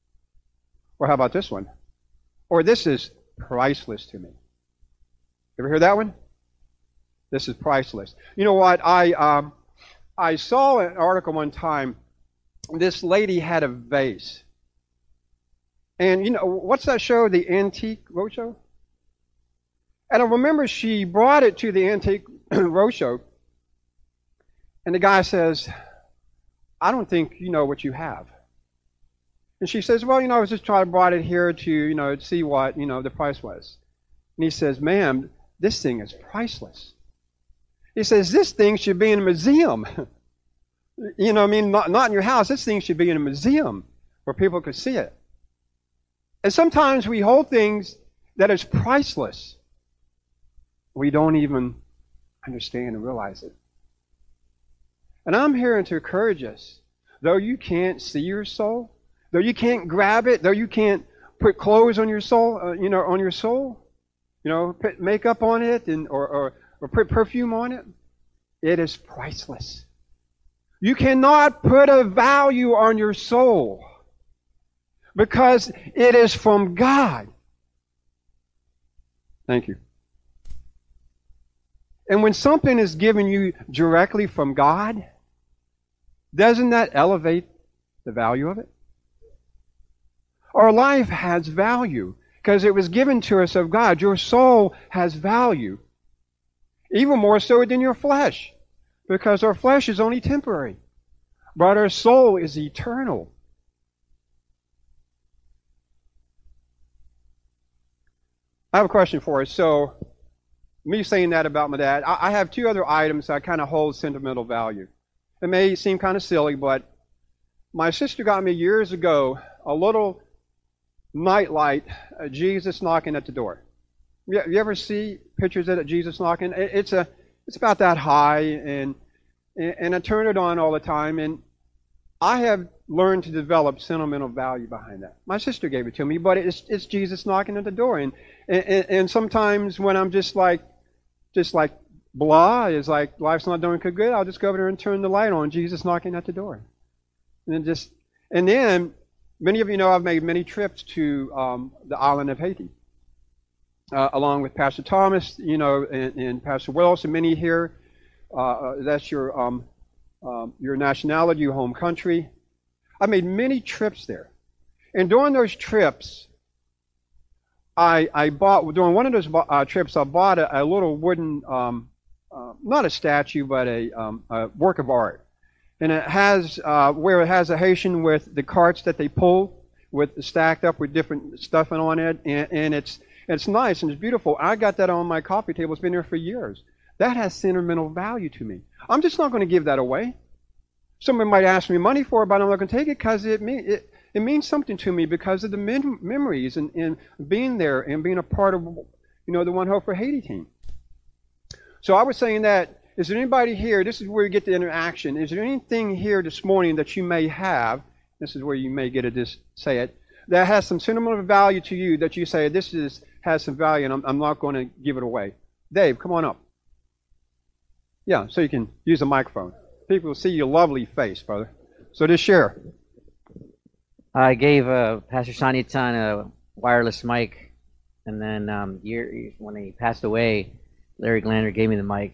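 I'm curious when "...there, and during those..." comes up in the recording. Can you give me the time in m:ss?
2:44.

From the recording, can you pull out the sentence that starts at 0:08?
I um, I saw an article one time.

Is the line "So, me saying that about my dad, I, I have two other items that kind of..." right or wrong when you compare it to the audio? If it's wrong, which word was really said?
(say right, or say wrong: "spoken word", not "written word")
right.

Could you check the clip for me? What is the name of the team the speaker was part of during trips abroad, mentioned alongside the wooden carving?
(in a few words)
One Hope for Haiti.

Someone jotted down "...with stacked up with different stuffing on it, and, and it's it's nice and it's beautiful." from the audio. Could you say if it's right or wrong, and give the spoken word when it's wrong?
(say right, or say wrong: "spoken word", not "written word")
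right.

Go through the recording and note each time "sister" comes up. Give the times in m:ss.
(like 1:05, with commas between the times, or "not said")
1:57, 2:15.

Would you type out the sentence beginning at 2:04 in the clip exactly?
You, you ever see pictures of Jesus knocking?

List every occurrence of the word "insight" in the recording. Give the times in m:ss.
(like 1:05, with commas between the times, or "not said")
not said.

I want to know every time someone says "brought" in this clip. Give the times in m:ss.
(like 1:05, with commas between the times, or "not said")
0:21, 0:30.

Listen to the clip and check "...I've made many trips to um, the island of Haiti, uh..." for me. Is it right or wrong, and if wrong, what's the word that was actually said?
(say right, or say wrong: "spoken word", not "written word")
right.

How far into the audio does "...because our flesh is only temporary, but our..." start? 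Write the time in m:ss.
1:39.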